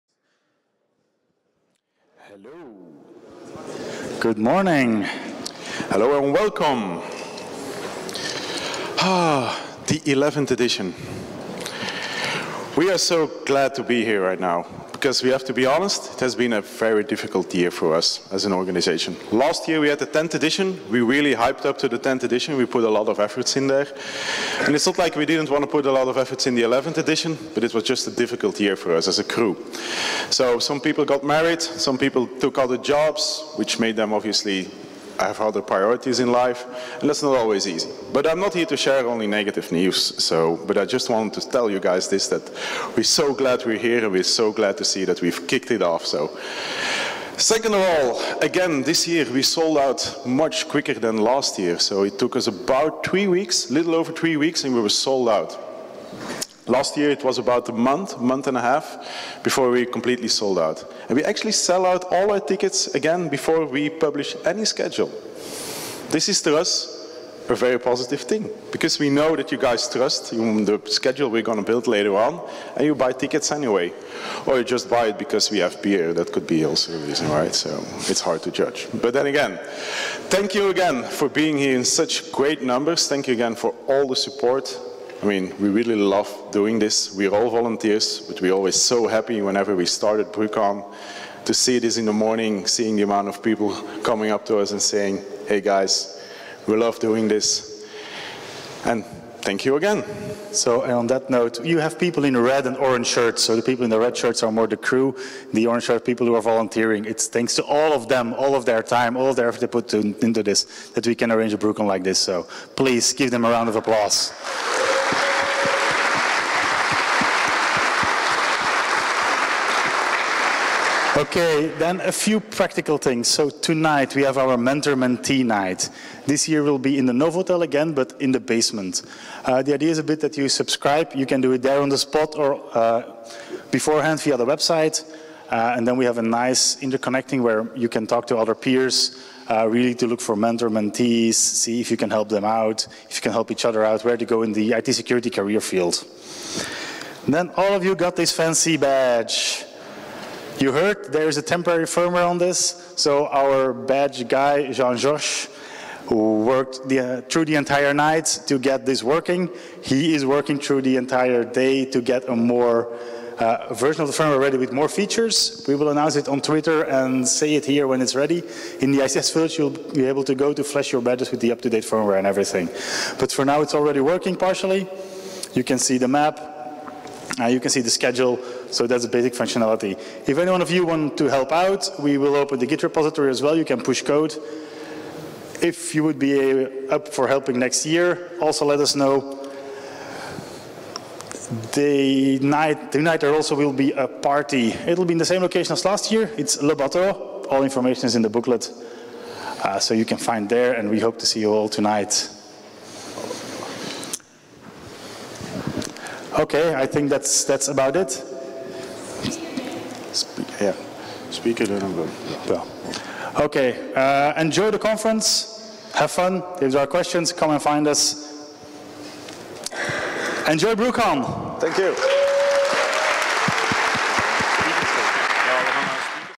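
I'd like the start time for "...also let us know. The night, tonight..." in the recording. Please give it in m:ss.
3:08.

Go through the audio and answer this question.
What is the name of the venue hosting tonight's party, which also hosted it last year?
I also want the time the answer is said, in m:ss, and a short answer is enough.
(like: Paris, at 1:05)
Le Bateau, at 3:16.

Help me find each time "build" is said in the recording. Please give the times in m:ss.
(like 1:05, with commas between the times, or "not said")
1:11.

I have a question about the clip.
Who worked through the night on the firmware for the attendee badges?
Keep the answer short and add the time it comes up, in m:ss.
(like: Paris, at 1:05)
Jean-Josh, at 2:34.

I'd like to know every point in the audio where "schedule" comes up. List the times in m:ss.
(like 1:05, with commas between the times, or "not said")
1:04, 1:10, 2:57.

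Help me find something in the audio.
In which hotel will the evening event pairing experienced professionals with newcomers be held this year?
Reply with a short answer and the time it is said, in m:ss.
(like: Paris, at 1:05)
Novotel, at 2:07.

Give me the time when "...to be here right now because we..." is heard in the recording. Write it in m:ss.
0:13.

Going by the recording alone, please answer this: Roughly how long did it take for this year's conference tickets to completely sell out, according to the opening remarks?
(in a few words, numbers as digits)
little over 3 weeks.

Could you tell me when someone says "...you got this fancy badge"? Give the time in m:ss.
2:27.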